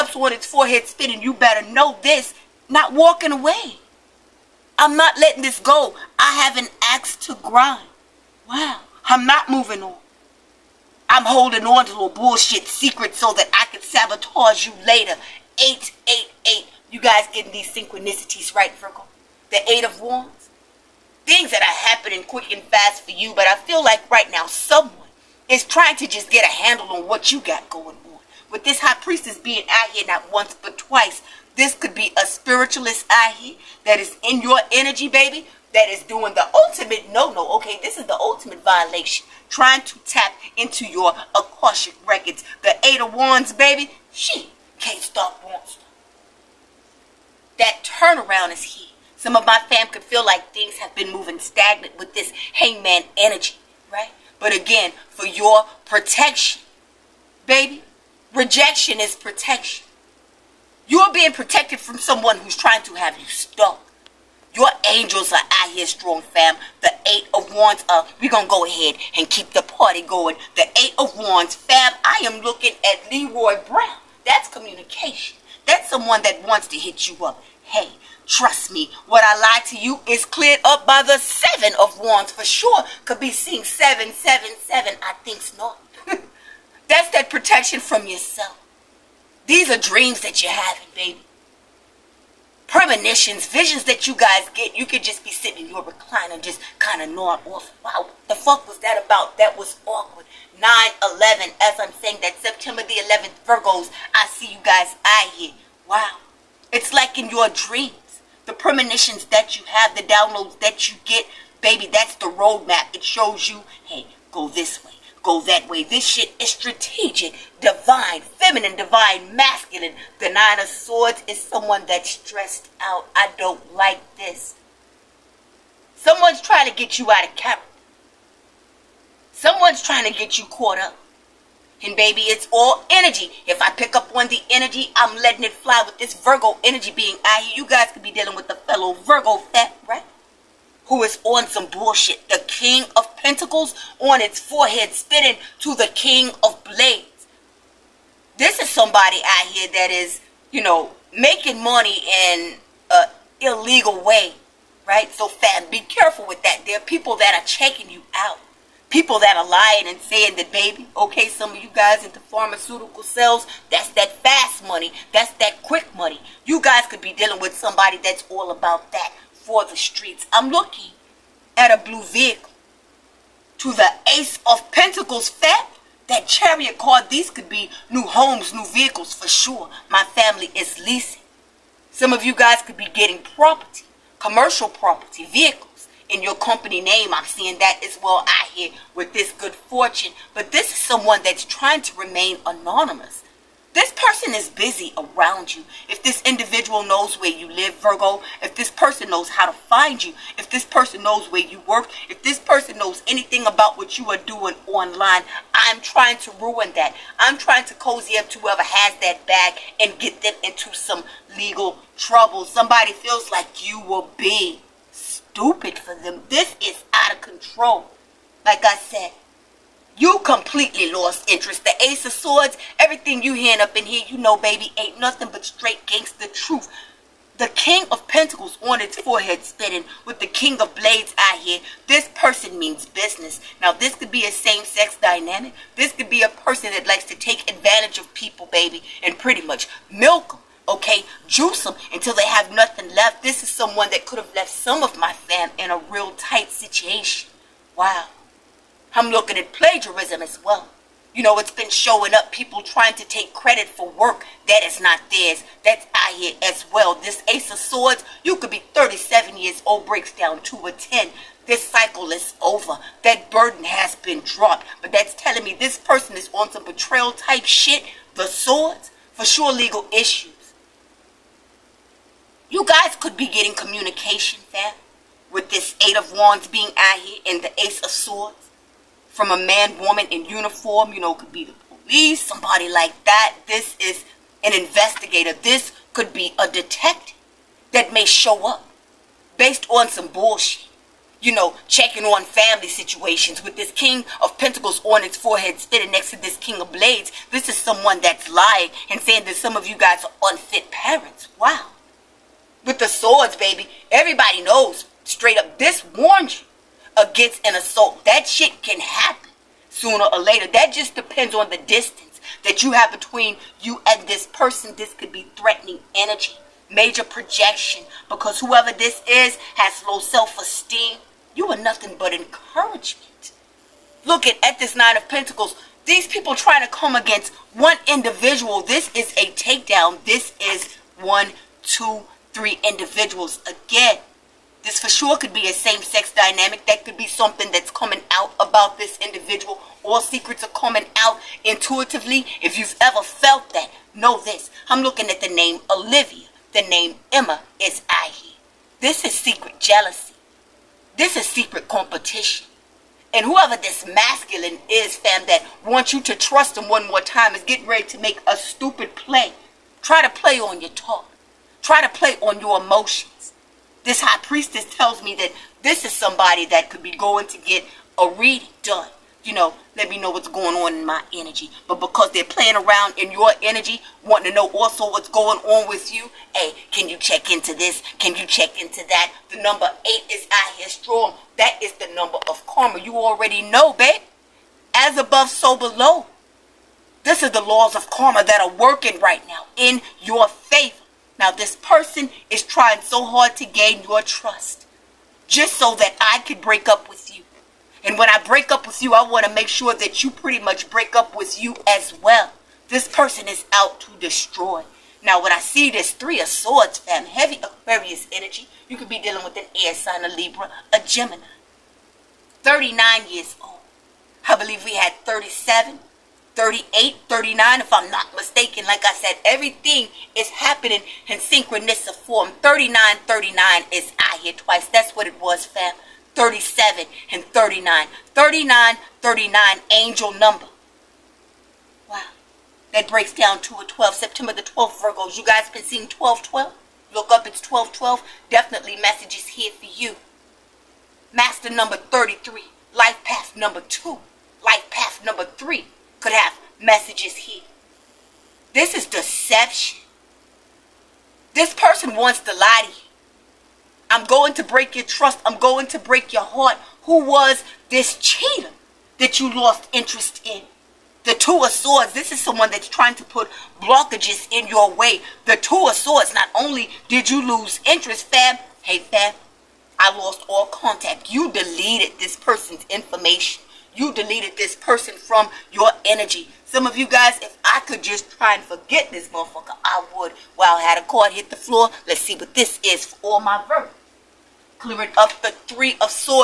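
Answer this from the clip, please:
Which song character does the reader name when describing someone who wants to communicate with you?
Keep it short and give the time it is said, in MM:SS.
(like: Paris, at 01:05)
Leroy Brown, at 01:13.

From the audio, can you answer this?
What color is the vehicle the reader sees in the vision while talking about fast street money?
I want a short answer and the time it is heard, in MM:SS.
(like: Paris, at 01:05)
blue, at 02:51.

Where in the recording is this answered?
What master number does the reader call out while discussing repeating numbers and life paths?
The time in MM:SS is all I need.
07:21.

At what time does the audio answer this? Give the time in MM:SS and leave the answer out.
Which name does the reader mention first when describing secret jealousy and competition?
05:45.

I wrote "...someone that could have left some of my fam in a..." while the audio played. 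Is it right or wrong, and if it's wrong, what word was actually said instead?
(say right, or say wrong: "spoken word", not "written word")
right.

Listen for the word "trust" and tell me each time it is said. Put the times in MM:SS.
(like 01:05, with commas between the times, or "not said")
01:18, 05:56, 06:34, 07:34.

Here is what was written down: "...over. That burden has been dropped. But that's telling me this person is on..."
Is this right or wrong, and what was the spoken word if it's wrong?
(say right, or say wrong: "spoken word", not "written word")
right.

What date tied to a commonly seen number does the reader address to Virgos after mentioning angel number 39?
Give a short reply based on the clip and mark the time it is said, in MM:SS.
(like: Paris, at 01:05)
September 12, at 07:13.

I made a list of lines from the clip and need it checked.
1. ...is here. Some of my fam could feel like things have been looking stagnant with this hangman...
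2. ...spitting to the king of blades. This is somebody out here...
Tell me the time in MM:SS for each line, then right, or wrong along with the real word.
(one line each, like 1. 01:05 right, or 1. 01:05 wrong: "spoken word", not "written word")
1. 00:48 wrong: "moving", not "looking"
2. 02:24 right.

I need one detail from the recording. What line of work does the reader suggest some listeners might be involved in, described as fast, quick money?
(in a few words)
pharmaceutical sales.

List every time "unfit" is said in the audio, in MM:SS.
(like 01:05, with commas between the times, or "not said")
05:00.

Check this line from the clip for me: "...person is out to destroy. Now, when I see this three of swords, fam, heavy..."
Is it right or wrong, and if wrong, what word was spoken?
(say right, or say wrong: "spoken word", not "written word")
right.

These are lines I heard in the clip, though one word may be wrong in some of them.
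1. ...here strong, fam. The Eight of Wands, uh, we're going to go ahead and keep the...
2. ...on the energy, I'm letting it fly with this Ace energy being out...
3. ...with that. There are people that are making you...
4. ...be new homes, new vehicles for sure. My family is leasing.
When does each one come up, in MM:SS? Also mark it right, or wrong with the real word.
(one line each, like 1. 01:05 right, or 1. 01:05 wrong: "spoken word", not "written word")
1. 01:05 right
2. 02:14 wrong: "Virgo", not "Ace"
3. 02:36 wrong: "checking", not "making"
4. 02:57 right.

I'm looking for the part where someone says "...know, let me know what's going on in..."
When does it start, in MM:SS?
06:09.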